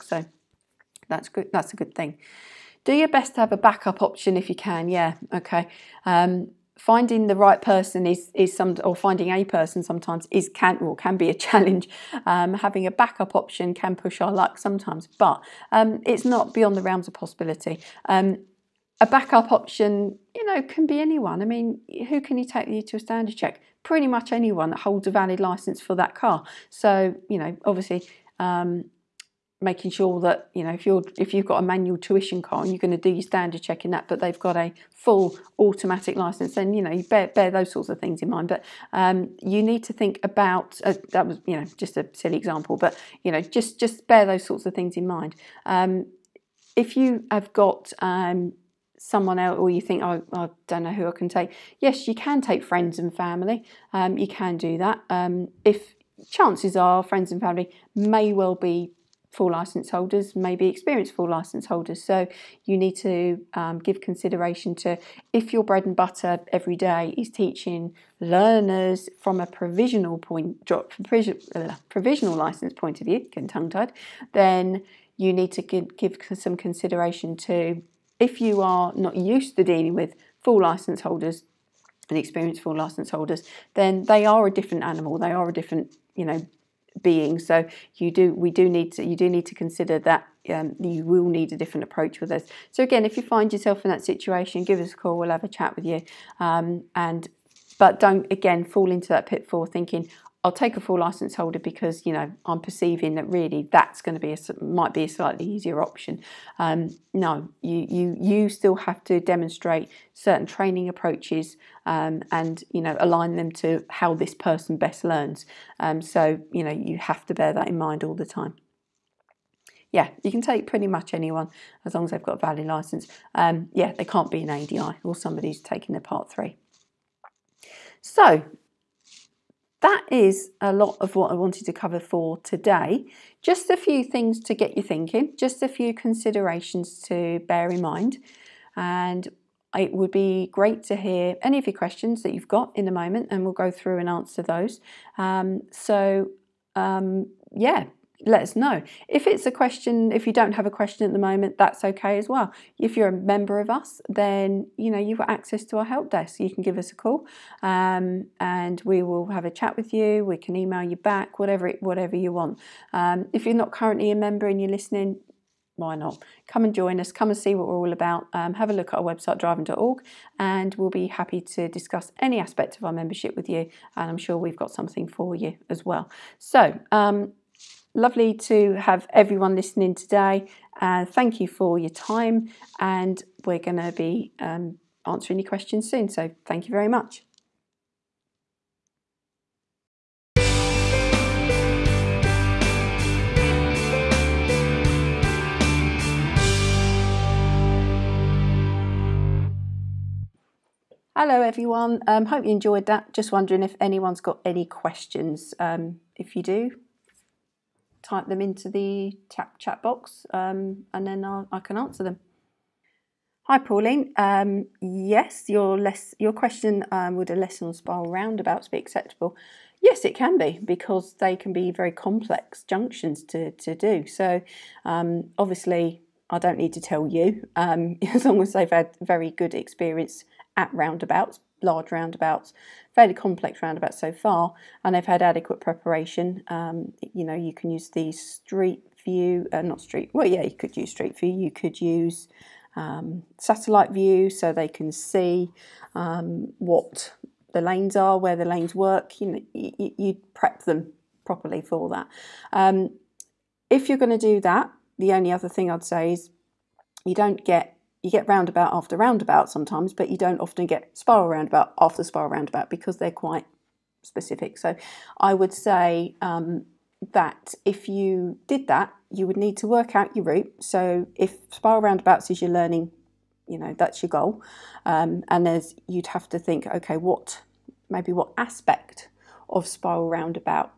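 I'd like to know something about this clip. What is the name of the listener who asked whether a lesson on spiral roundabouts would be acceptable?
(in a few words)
Pauline.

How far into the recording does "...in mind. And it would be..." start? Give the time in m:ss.
2:17.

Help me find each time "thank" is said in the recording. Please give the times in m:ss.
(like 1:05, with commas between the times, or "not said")
3:01, 3:06.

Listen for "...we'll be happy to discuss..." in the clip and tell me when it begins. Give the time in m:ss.
2:50.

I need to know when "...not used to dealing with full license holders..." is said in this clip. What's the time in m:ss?
1:18.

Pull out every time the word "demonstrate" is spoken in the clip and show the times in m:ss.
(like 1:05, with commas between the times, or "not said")
1:49.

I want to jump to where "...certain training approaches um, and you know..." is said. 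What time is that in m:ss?
1:50.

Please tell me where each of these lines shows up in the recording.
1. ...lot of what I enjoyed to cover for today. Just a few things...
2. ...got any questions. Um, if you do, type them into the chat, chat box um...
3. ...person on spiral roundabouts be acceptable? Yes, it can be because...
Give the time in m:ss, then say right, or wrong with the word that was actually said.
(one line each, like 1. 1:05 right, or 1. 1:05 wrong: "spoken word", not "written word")
1. 2:10 wrong: "wanted", not "enjoyed"
2. 3:24 right
3. 3:37 wrong: "lesson", not "person".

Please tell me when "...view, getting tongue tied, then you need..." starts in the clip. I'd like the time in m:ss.
1:13.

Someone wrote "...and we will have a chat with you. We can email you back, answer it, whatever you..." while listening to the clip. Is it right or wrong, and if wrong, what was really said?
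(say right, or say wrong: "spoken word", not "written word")
wrong: "whatever", not "answer".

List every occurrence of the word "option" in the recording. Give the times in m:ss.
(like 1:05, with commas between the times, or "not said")
0:04, 0:13, 0:19, 1:45.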